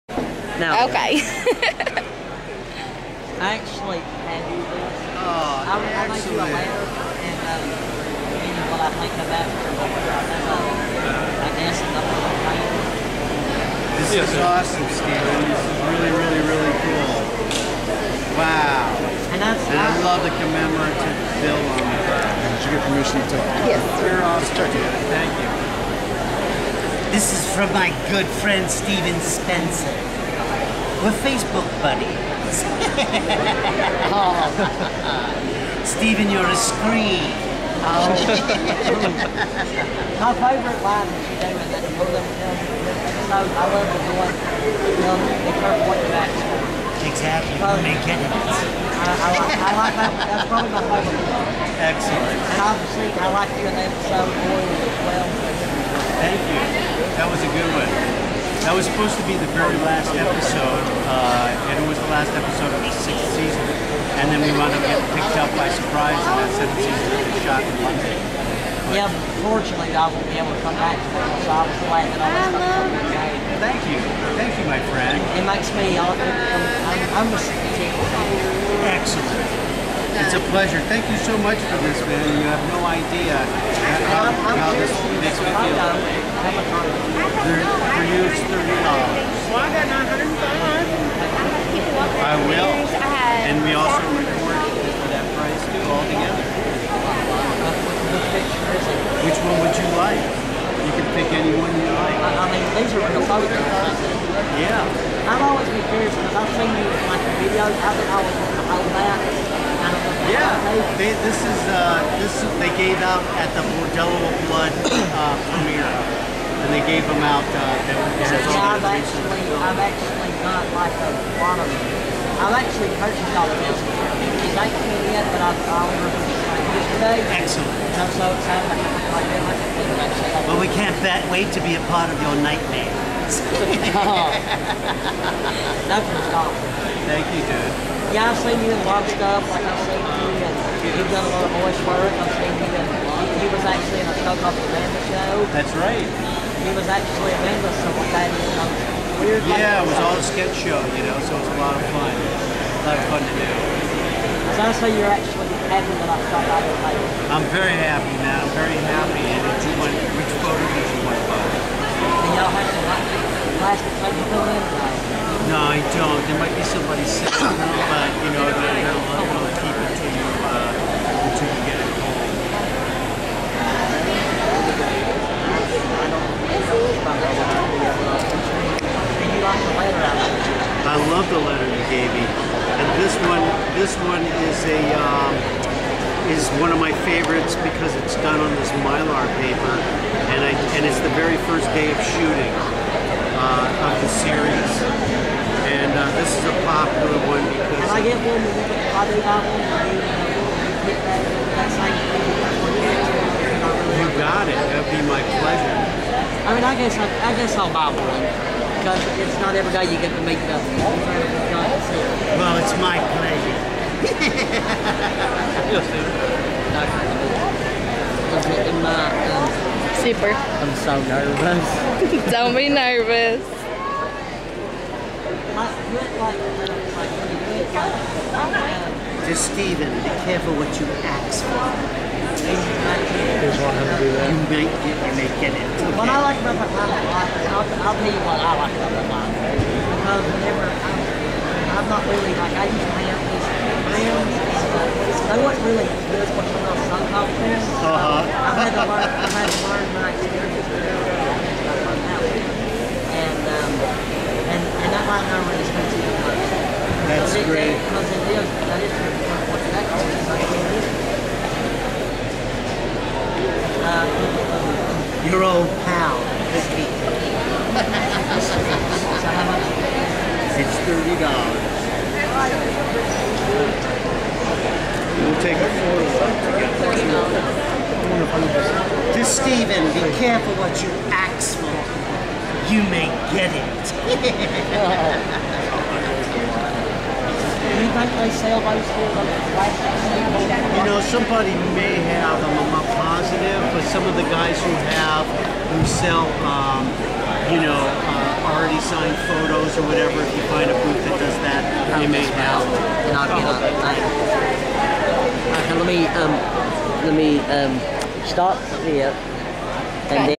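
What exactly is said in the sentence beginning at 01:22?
You have no idea how, how this makes me feel.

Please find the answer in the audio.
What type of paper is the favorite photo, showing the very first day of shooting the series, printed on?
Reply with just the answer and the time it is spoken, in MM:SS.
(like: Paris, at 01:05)
Mylar, at 03:08.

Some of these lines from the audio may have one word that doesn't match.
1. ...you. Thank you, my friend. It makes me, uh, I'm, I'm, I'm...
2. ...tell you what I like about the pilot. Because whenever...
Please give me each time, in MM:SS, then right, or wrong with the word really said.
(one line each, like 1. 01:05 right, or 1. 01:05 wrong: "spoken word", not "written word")
1. 01:13 right
2. 03:57 right.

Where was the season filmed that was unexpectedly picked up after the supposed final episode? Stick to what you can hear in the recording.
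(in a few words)
London.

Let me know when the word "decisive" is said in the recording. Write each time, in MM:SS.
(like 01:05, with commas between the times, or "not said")
not said.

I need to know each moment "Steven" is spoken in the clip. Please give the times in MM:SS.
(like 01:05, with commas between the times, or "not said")
00:14, 00:28, 00:35, 03:49, 04:39.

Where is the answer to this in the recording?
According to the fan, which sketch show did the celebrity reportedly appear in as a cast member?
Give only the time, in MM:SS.
02:24.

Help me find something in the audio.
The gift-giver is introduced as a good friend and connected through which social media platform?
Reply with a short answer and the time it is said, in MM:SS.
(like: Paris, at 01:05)
Facebook, at 00:31.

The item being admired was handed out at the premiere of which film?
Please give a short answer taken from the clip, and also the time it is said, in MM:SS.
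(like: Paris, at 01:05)
Bordello of Blood, at 01:53.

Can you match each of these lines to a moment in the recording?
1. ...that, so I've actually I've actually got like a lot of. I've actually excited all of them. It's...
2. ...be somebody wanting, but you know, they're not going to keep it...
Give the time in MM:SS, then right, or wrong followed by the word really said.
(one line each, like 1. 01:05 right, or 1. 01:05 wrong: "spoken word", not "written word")
1. 01:57 wrong: "purchased", not "excited"
2. 02:46 wrong: "sitting", not "wanting".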